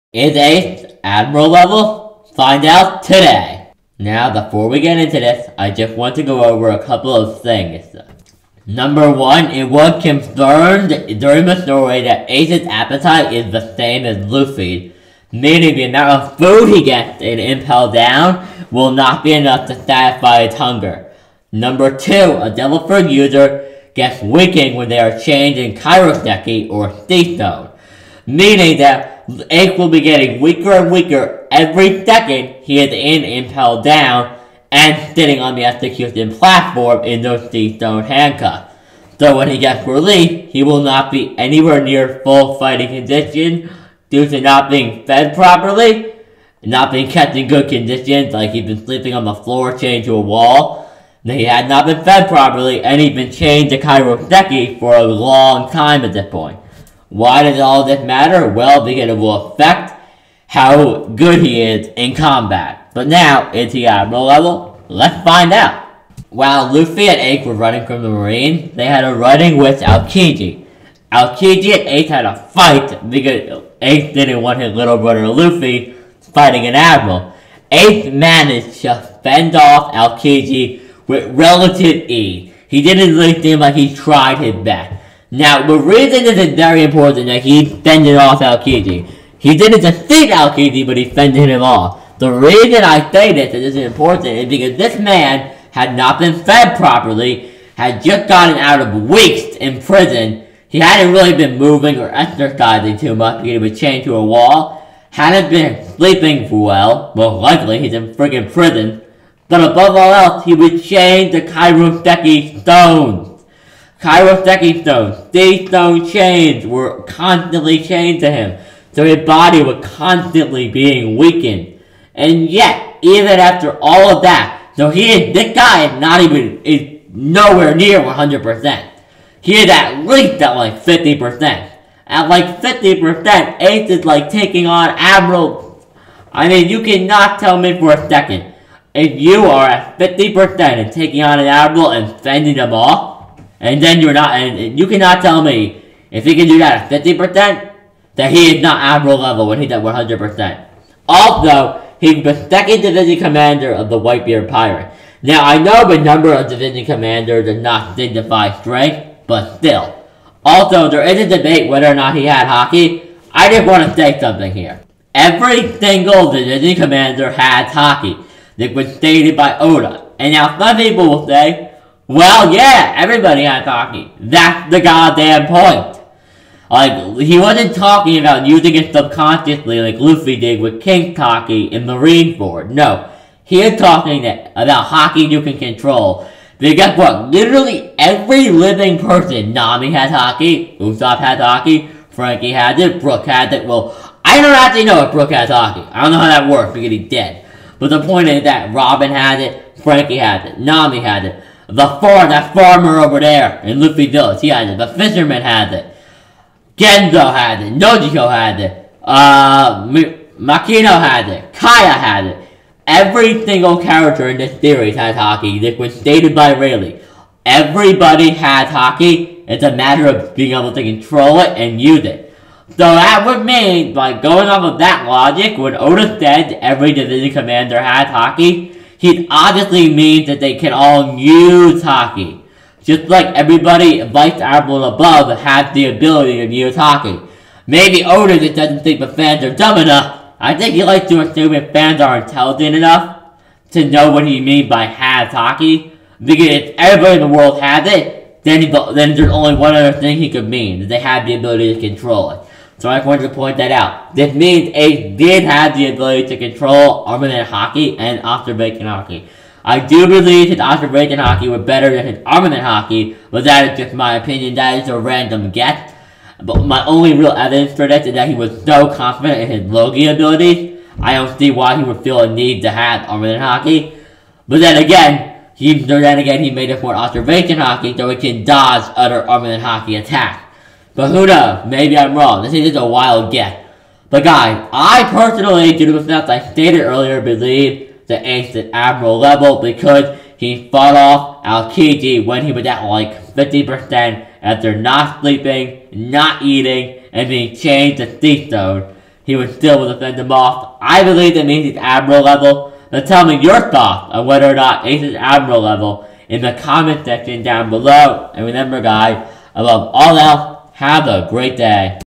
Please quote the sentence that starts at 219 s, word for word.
It's a matter of being able to control it and use it.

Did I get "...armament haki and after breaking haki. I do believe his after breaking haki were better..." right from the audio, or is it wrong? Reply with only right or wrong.
right.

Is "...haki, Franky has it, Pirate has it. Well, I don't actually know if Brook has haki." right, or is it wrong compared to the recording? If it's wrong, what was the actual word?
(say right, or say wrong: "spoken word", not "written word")
wrong: "Brook", not "Pirate".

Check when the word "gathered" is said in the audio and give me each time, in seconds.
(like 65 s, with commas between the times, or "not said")
not said.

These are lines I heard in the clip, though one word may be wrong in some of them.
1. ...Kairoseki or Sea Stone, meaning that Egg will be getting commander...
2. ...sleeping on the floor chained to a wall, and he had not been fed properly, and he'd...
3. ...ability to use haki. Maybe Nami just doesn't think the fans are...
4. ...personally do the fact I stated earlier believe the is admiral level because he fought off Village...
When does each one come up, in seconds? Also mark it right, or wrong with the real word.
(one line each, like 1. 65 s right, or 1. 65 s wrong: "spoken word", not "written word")
1. 25 s wrong: "weaker", not "commander"
2. 48 s right
3. 235 s wrong: "Oda", not "Nami"
4. 285 s wrong: "Aokiji", not "Village".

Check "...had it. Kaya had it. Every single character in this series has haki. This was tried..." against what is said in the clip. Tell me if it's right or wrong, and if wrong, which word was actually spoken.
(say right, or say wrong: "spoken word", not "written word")
wrong: "stated", not "tried".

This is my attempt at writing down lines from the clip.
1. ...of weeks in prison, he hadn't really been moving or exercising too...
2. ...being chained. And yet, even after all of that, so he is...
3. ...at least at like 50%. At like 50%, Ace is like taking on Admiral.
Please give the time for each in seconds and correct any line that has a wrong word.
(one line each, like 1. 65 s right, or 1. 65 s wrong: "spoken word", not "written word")
1. 98 s right
2. 120 s wrong: "weakened", not "chained"
3. 129 s right.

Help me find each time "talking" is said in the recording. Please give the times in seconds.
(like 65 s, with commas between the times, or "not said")
177 s, 183 s.